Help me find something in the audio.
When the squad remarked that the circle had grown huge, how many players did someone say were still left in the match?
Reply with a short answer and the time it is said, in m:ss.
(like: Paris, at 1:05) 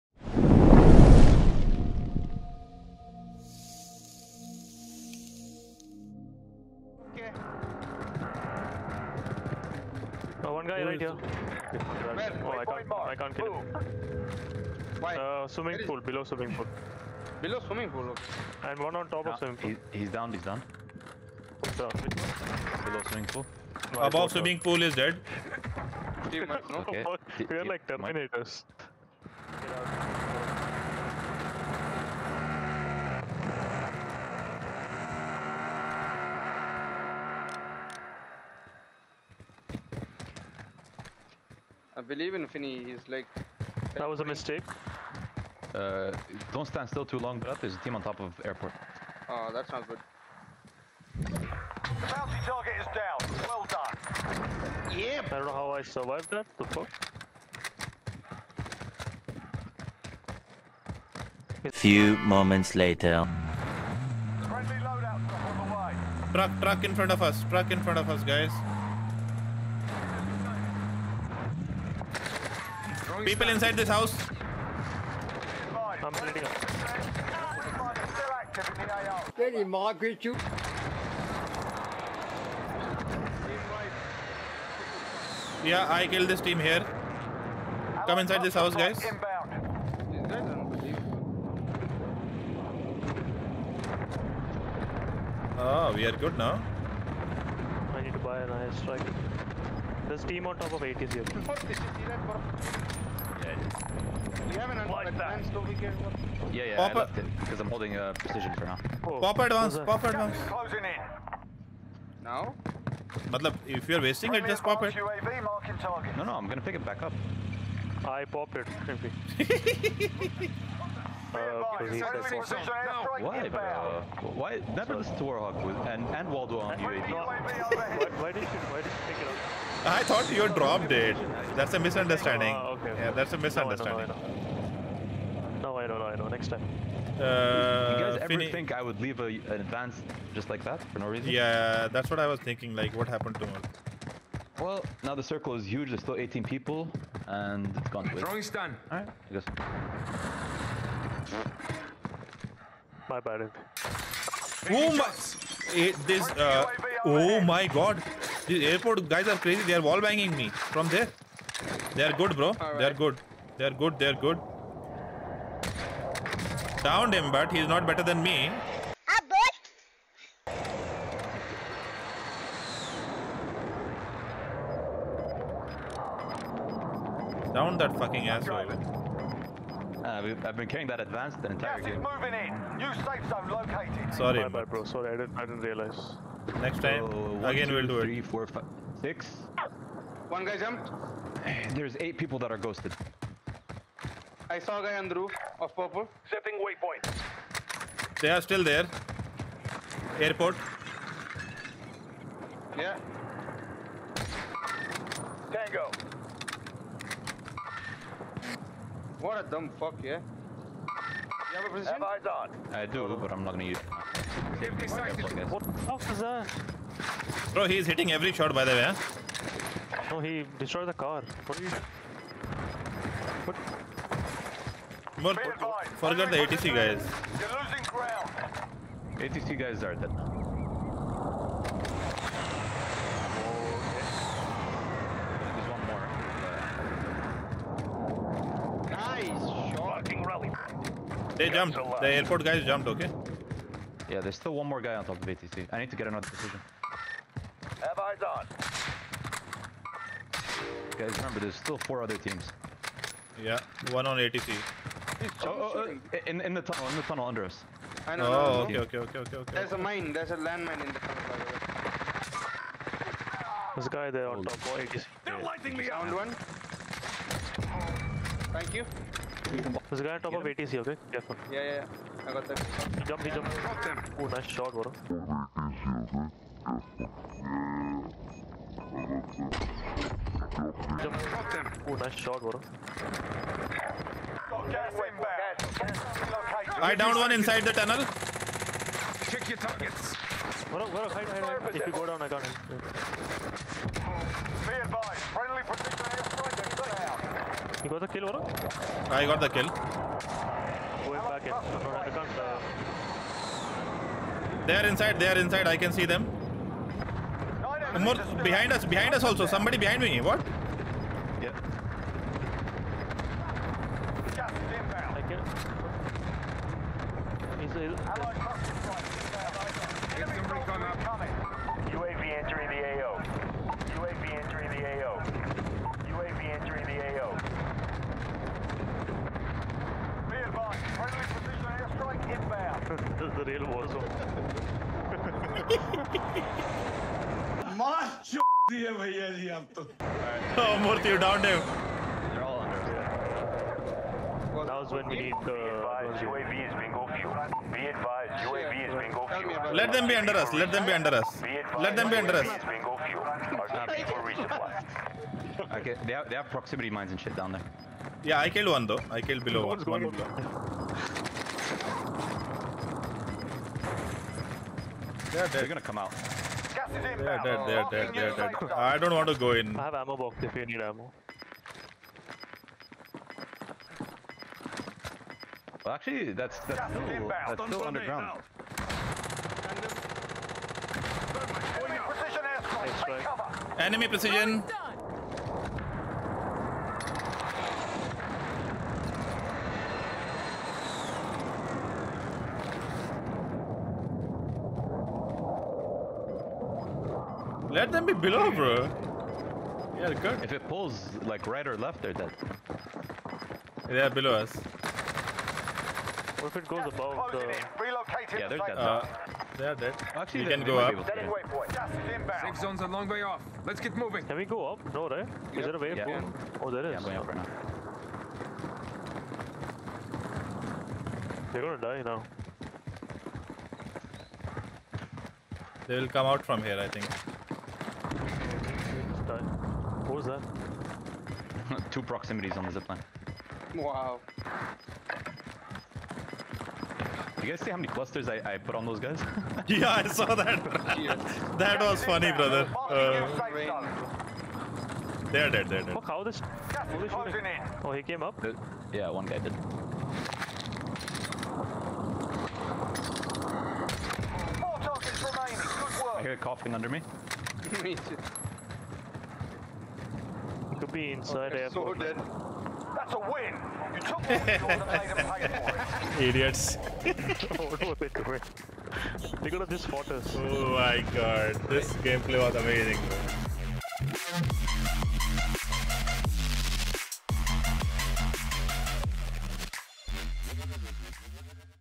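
18, at 2:26.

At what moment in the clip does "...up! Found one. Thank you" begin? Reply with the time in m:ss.
4:25.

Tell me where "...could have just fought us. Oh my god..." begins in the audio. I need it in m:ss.
7:49.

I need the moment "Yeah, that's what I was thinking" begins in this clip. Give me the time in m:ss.
2:21.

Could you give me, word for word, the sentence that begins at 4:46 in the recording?
I downed one inside the tunnel.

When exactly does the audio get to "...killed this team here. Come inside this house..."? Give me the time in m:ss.
1:26.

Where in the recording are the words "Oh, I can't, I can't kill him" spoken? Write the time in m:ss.
0:11.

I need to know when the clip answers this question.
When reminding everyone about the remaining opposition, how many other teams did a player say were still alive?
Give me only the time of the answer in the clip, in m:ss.
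4:11.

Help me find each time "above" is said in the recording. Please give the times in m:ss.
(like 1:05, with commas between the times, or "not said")
0:24, 6:46.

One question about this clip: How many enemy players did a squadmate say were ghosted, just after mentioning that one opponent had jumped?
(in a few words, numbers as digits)
8.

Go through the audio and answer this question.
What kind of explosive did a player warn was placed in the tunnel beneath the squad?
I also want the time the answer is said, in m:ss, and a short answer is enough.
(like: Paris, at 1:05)
landmine, at 4:20.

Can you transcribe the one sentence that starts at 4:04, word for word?
Yeah, there's still one more guy on top of ATC.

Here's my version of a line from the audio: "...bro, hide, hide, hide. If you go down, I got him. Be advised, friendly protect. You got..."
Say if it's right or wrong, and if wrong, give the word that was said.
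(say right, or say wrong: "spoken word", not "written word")
right.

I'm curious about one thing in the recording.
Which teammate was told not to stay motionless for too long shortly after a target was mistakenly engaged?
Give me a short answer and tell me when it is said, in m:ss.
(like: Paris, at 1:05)
Brad, at 0:47.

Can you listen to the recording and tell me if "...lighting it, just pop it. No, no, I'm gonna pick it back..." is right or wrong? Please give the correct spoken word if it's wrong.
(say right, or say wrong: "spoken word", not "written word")
wrong: "wasting", not "lighting".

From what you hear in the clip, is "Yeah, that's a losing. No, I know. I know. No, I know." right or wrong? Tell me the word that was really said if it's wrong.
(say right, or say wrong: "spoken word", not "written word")
wrong: "misunderstanding", not "losing".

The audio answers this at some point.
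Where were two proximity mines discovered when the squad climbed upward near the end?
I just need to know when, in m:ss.
7:12.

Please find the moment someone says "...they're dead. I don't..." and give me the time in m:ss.
6:08.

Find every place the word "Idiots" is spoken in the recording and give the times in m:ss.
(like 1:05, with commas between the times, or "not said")
7:46.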